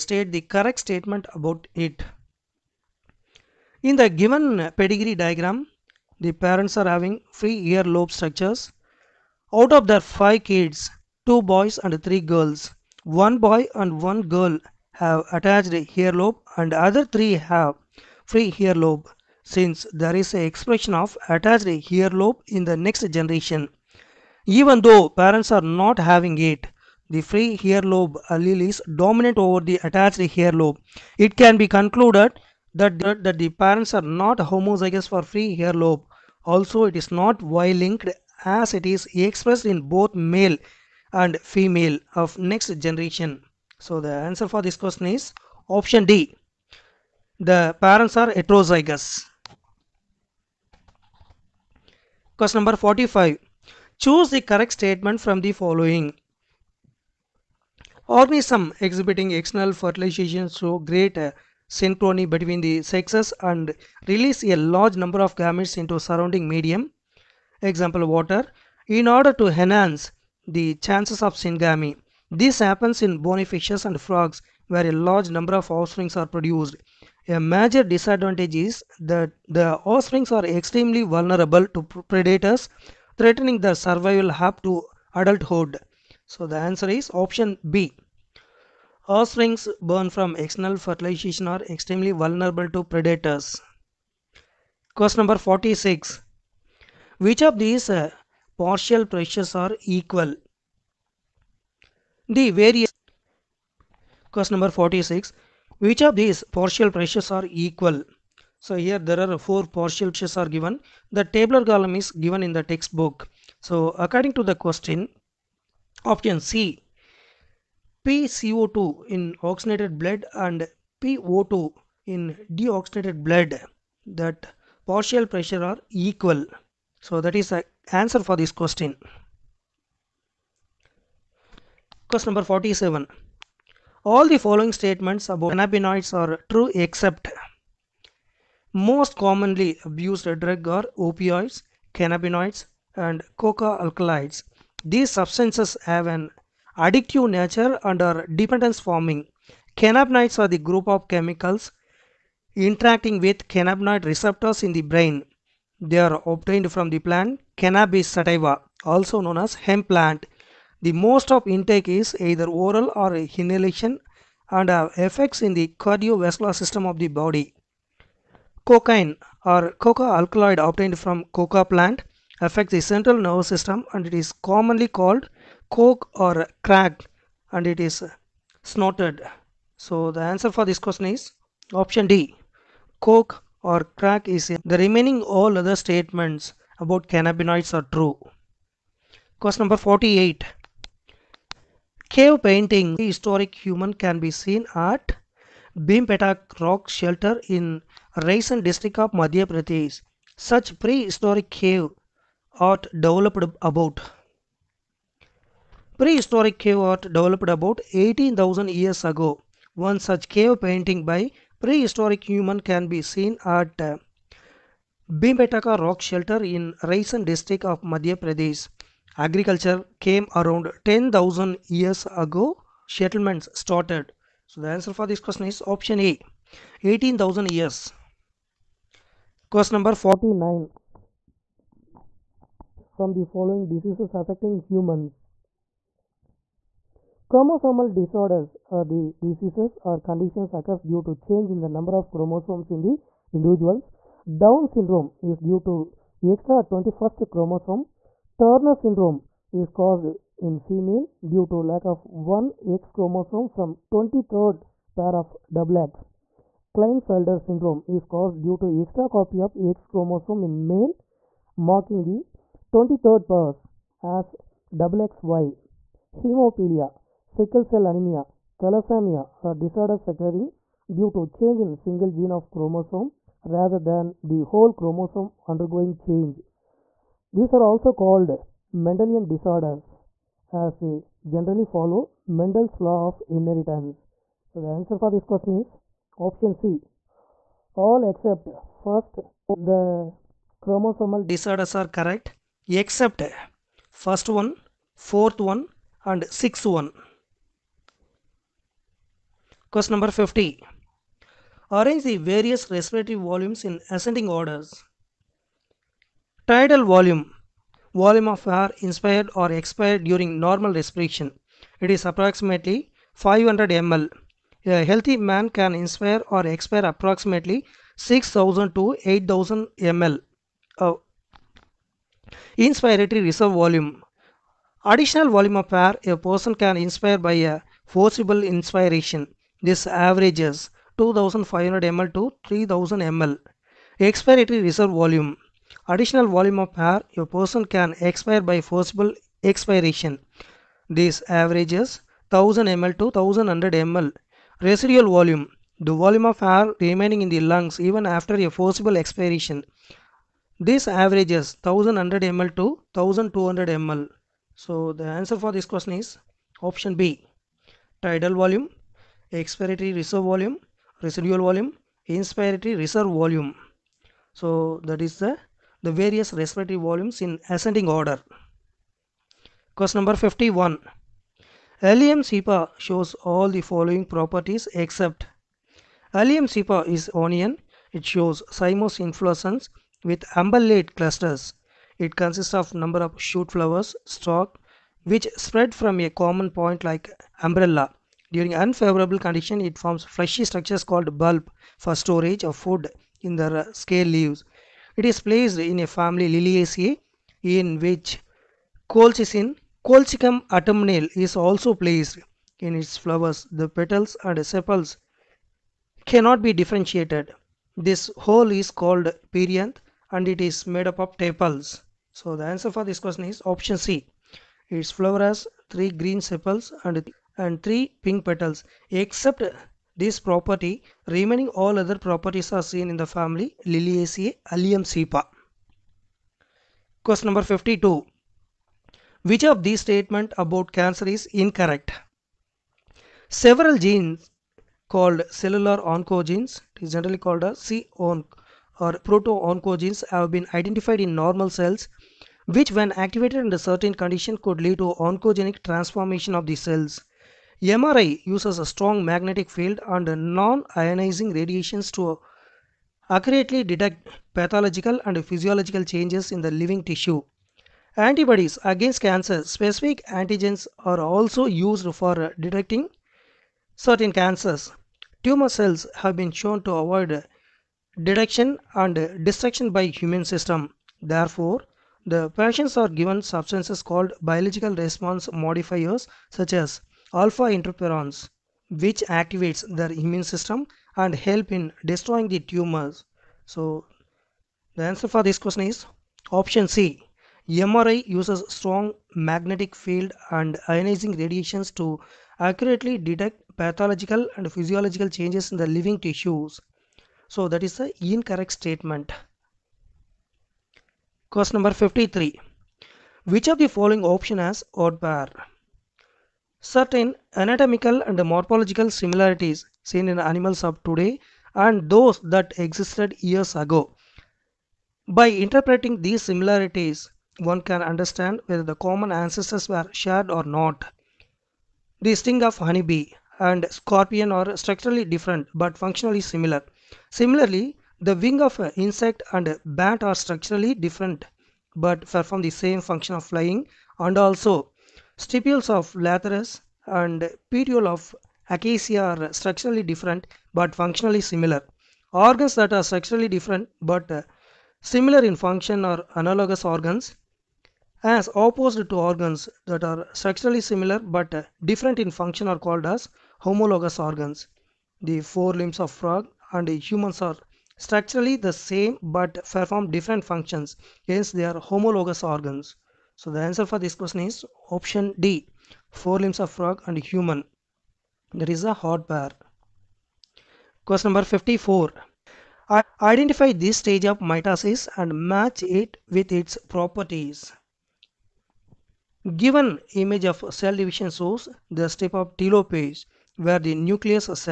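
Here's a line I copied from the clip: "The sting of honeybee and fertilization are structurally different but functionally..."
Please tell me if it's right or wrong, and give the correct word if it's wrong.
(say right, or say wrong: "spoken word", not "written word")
wrong: "scorpion", not "fertilization".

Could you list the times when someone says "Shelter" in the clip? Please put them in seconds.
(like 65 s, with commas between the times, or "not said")
196 s, 216 s.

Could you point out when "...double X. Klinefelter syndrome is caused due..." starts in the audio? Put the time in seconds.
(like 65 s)
255 s.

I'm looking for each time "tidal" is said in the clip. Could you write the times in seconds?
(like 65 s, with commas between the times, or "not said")
306 s, 358 s.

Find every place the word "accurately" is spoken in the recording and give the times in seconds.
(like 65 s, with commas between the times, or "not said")
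453 s, 492 s.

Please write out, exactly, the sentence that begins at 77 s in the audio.
A major disadvantage is that the offsprings are extremely vulnerable to predators threatening their survival up to adulthood.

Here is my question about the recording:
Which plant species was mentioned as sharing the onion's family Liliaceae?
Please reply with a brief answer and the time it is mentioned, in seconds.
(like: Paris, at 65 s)
Colchicum autumnale, at 399 s.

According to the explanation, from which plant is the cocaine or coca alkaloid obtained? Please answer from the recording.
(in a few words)
coca plant.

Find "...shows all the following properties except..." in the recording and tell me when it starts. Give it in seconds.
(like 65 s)
372 s.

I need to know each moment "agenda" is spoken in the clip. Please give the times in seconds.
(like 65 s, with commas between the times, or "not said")
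not said.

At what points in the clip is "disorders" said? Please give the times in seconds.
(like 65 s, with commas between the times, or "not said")
237 s, 269 s, 279 s, 291 s.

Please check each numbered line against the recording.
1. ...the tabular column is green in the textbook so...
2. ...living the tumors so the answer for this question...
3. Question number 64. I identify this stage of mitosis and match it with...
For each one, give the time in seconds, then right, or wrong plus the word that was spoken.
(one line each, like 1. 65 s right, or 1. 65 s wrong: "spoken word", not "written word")
1. 111 s wrong: "given", not "green"
2. 481 s wrong: "destroying", not "living"
3. 570 s wrong: "54", not "64".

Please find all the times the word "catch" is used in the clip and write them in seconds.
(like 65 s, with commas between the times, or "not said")
not said.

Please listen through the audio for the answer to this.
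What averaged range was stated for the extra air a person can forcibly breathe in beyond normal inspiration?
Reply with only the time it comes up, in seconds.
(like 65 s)
330 s.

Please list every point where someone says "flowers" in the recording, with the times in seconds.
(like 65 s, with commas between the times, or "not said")
383 s, 402 s, 414 s.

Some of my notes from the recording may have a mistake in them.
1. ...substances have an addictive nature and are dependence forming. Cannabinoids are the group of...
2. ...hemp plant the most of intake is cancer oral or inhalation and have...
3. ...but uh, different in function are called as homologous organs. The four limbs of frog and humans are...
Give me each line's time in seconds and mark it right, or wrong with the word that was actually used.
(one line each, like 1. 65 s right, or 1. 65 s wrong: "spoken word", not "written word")
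1. 145 s right
2. 159 s wrong: "either", not "cancer"
3. 551 s right.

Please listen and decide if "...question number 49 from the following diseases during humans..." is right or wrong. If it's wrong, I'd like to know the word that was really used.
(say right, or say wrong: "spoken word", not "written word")
wrong: "affecting", not "during".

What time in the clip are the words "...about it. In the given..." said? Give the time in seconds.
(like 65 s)
1 s.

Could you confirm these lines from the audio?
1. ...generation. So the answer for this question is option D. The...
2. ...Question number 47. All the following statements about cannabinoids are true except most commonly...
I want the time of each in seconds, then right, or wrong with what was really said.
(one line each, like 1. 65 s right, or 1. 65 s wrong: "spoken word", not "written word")
1. 42 s right
2. 132 s right.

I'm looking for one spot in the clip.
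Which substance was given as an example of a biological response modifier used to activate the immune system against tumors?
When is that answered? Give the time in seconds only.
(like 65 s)
477 s.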